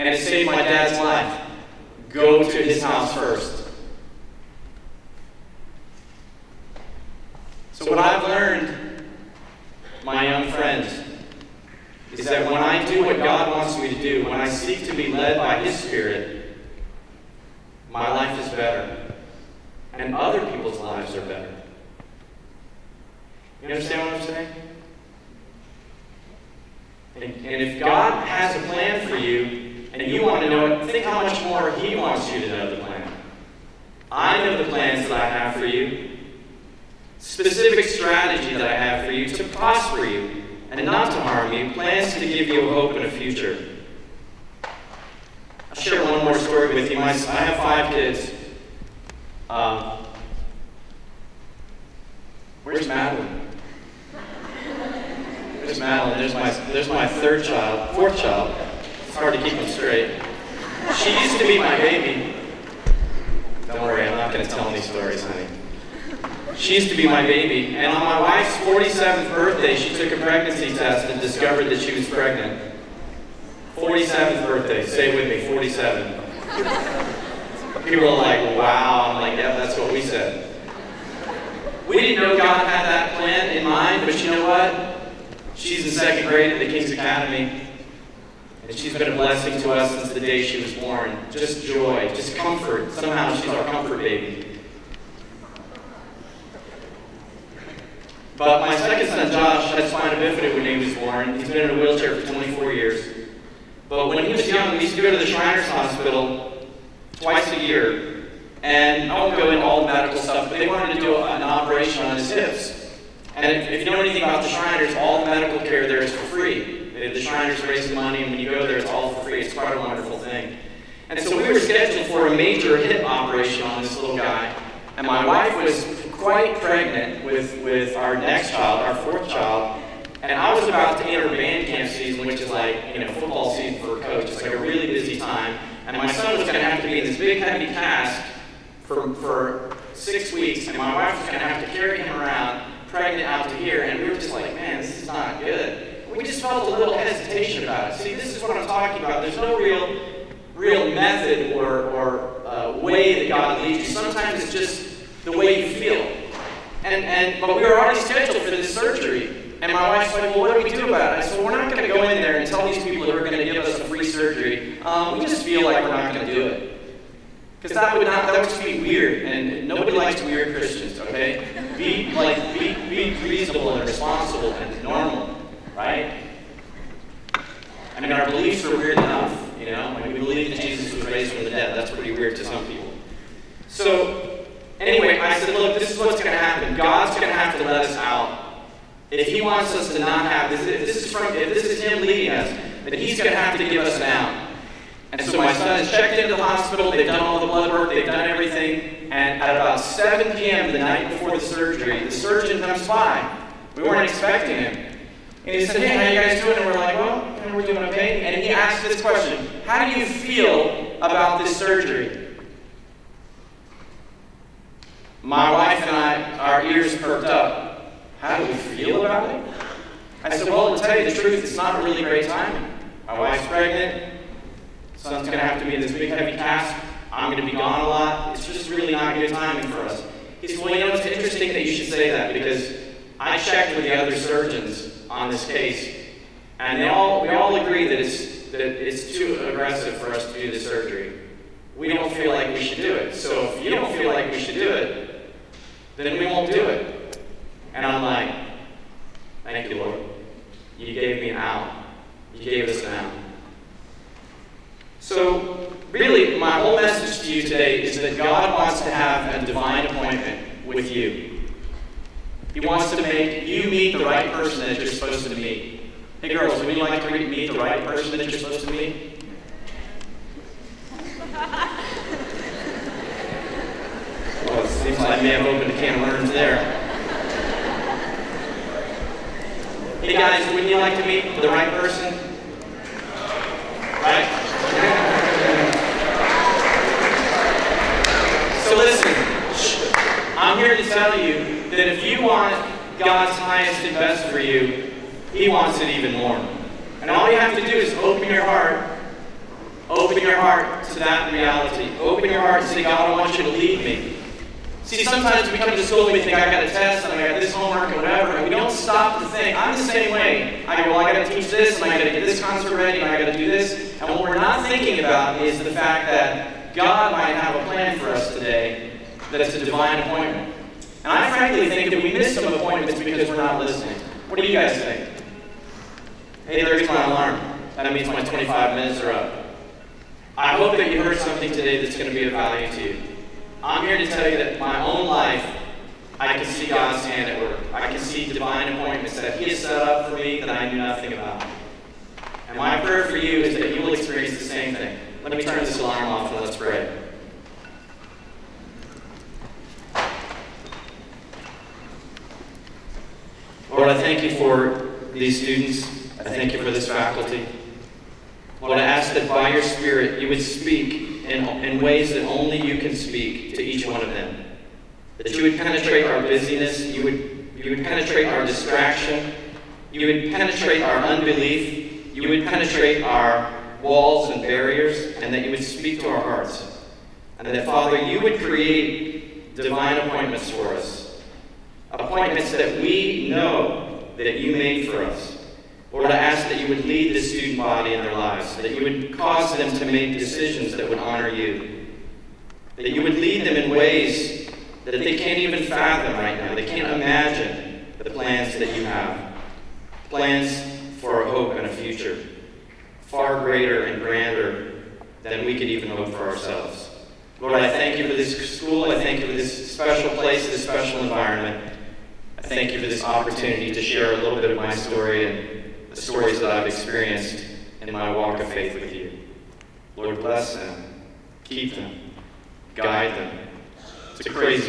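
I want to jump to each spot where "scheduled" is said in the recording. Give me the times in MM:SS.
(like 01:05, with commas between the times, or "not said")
02:01, 02:37.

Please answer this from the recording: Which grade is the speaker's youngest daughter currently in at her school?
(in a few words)
second grade.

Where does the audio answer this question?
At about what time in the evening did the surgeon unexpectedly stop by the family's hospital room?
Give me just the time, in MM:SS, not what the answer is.
03:19.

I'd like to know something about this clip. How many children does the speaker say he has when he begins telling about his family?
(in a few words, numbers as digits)
5.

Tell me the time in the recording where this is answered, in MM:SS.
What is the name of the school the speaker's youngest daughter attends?
01:26.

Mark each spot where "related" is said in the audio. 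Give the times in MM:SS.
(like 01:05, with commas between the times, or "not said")
not said.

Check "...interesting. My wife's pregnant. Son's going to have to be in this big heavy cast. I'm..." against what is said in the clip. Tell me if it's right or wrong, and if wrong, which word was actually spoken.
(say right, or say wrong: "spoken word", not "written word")
wrong: "timing", not "interesting".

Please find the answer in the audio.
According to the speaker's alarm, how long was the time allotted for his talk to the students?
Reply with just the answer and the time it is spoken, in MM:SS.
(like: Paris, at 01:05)
25 minutes, at 05:28.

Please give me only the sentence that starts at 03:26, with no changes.
And we're like, well, we're doing okay.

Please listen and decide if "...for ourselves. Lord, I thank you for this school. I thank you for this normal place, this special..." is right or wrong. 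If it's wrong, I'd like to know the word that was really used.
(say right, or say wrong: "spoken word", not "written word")
wrong: "special", not "normal".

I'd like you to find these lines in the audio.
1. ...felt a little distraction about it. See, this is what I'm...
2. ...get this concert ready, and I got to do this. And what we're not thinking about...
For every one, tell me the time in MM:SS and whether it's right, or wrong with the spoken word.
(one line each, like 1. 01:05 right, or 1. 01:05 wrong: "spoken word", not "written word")
1. 02:26 wrong: "hesitation", not "distraction"
2. 05:12 right.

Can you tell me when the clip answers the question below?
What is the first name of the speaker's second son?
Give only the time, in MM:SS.
01:39.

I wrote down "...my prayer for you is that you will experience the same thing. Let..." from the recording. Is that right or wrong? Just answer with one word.
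right.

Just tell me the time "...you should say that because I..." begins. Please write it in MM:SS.
03:51.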